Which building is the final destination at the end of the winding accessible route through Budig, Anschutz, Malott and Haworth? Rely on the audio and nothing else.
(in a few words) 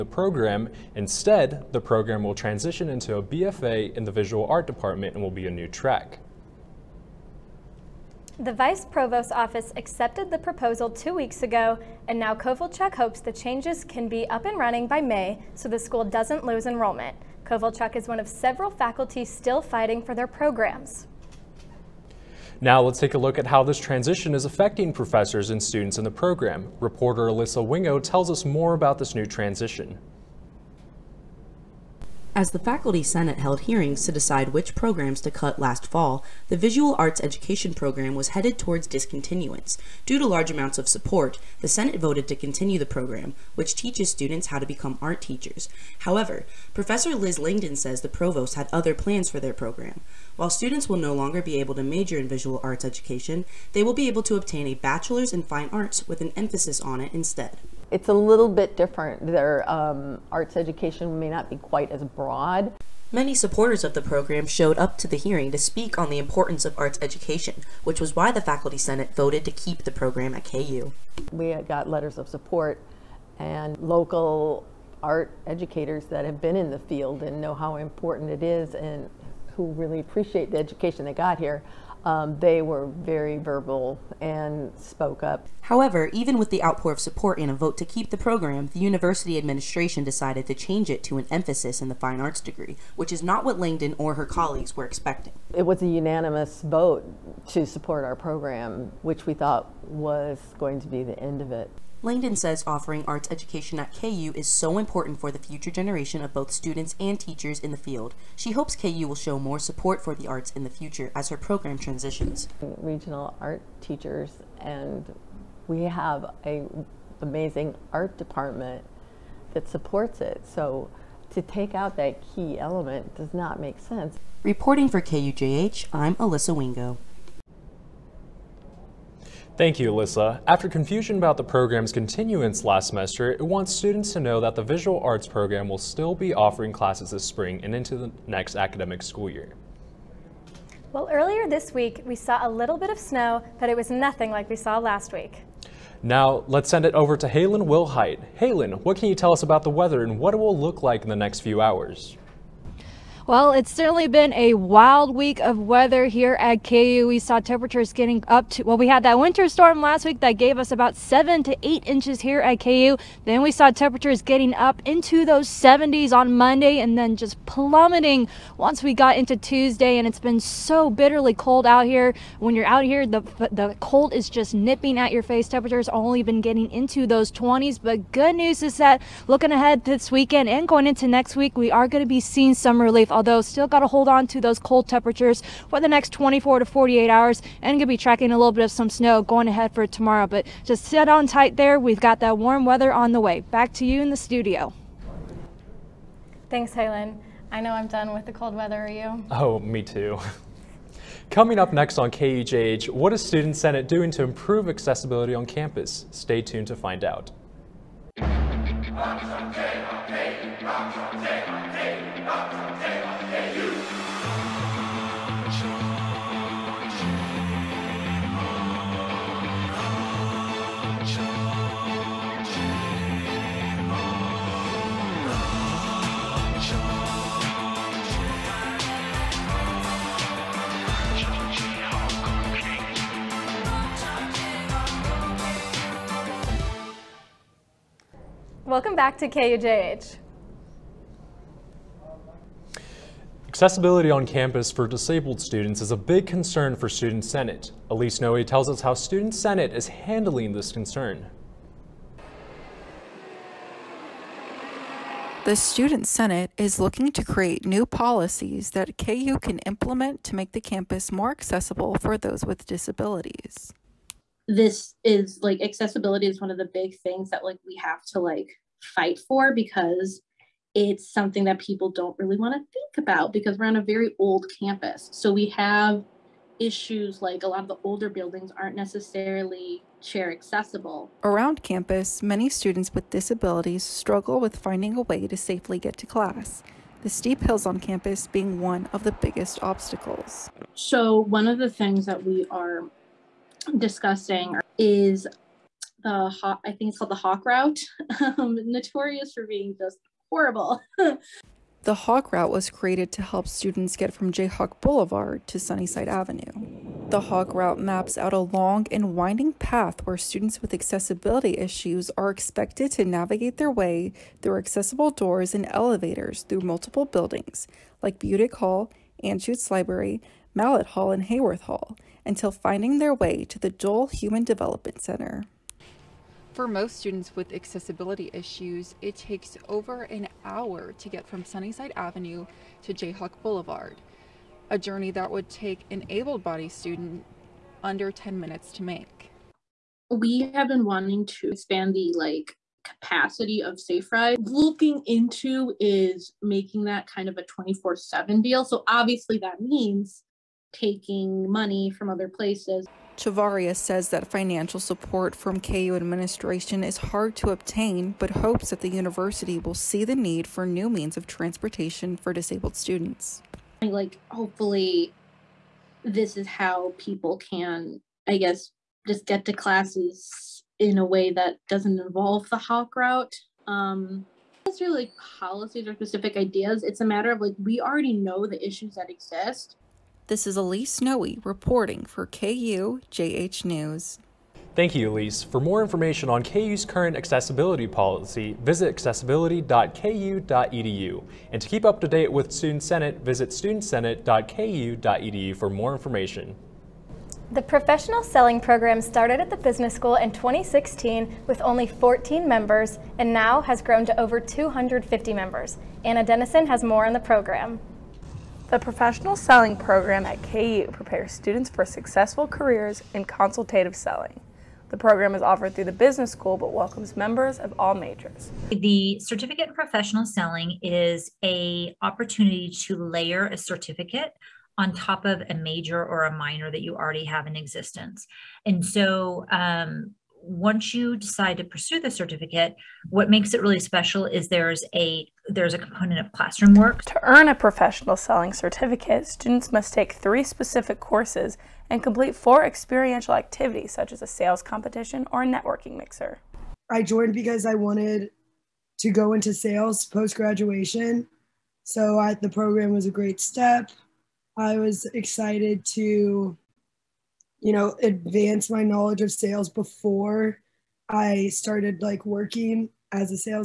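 Dole Human Development Center.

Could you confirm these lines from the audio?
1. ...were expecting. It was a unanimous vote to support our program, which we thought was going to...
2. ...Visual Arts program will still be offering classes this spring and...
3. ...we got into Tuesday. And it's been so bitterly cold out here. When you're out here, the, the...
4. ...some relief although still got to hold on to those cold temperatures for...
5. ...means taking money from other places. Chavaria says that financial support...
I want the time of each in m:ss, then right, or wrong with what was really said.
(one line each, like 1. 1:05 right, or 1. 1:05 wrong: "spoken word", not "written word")
1. 1:34 right
2. 2:14 right
3. 2:48 right
4. 3:02 right
5. 5:49 right.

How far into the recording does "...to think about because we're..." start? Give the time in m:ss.
4:32.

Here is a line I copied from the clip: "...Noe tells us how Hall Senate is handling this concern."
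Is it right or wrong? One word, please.
wrong.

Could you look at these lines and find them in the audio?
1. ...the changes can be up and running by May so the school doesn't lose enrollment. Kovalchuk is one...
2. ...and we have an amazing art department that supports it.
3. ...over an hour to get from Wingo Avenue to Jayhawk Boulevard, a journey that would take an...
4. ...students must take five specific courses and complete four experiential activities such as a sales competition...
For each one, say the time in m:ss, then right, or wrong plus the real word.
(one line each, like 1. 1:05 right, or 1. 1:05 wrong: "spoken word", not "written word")
1. 0:13 right
2. 1:54 right
3. 5:29 wrong: "Sunnyside", not "Wingo"
4. 7:19 wrong: "three", not "five".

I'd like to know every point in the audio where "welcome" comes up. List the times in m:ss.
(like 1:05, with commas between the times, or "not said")
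3:58, 6:56.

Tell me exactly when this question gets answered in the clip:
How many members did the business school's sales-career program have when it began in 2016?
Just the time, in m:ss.
6:41.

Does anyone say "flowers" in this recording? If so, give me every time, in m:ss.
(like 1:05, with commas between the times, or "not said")
not said.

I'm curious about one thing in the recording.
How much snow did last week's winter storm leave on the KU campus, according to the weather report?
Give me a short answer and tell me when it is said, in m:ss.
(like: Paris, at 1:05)
7 to 8 inches, at 2:40.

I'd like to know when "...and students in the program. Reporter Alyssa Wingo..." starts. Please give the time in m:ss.
0:25.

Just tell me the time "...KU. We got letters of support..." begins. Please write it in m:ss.
1:10.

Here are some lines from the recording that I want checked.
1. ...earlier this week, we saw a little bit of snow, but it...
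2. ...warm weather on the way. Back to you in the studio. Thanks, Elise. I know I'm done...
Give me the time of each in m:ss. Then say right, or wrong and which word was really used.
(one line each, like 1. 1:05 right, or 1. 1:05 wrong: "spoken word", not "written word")
1. 2:21 right
2. 3:12 wrong: "Helen", not "Elise".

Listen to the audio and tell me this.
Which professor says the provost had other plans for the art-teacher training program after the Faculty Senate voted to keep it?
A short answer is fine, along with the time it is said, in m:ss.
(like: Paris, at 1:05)
Liz Langdon, at 0:47.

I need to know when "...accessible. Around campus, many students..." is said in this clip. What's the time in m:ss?
4:40.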